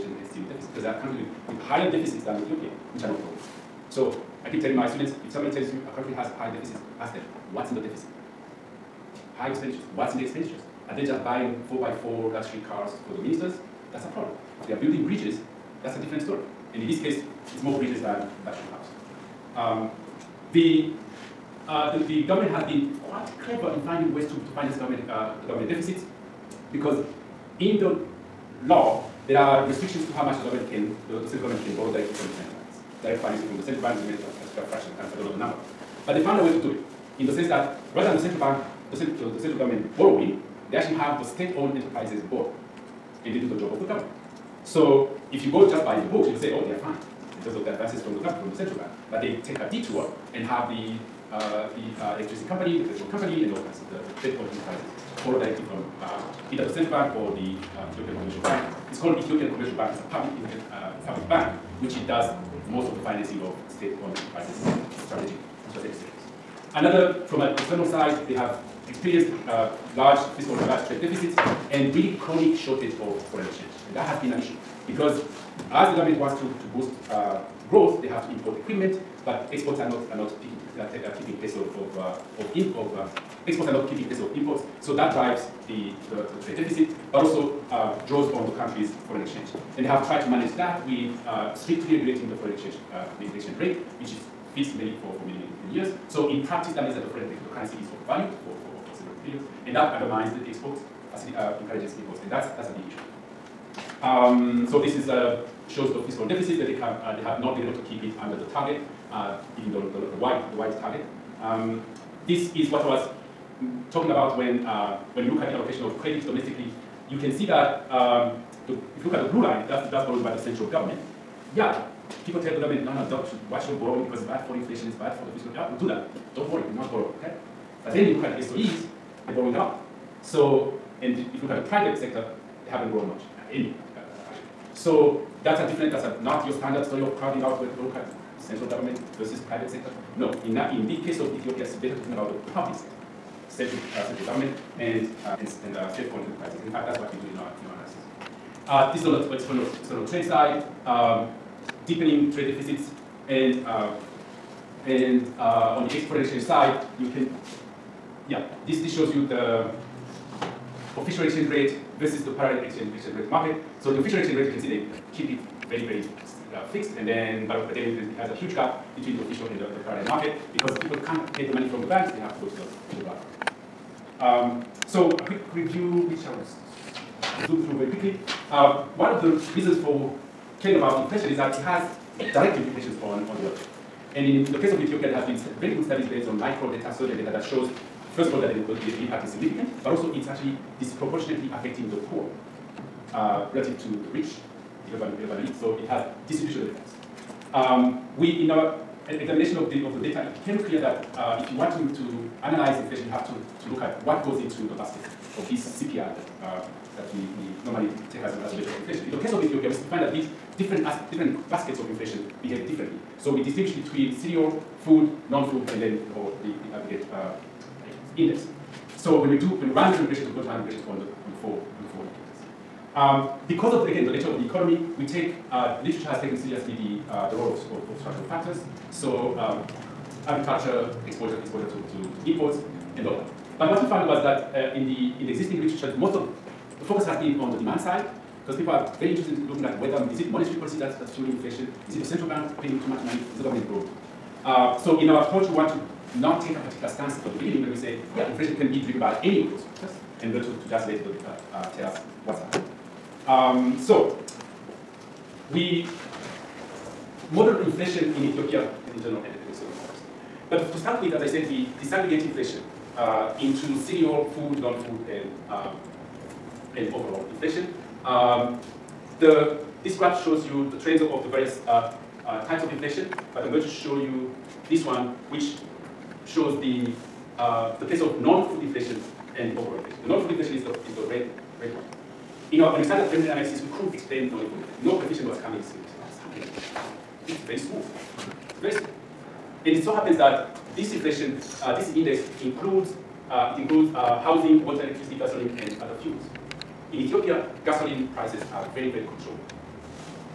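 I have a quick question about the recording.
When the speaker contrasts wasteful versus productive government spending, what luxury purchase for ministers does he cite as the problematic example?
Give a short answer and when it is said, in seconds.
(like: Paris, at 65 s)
4x4 luxury cars, at 11 s.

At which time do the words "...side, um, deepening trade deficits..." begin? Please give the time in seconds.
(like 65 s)
150 s.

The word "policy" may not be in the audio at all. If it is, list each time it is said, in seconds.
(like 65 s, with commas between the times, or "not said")
54 s, 240 s.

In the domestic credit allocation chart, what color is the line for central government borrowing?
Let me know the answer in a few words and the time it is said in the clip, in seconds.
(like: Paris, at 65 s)
Blue, at 119 s.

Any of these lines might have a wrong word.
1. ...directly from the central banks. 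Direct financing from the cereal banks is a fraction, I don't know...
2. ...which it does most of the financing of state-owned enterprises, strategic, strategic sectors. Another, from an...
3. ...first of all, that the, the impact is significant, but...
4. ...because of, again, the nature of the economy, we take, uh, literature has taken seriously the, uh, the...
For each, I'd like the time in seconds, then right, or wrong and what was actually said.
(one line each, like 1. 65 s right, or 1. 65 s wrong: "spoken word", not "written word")
1. 31 s wrong: "central", not "cereal"
2. 61 s right
3. 188 s right
4. 223 s right.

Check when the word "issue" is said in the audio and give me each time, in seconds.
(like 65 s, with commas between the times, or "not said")
74 s, 102 s.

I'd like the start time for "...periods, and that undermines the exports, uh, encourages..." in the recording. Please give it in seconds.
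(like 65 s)
99 s.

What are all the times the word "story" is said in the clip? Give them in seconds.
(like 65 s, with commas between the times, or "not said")
16 s, 136 s.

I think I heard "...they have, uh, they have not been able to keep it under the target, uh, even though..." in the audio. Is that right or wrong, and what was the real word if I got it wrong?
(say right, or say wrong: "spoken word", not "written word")
right.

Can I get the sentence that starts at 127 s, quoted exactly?
But then you look at the SOEs, they're borrowing a lot.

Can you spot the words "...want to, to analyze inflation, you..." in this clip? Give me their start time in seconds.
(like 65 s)
201 s.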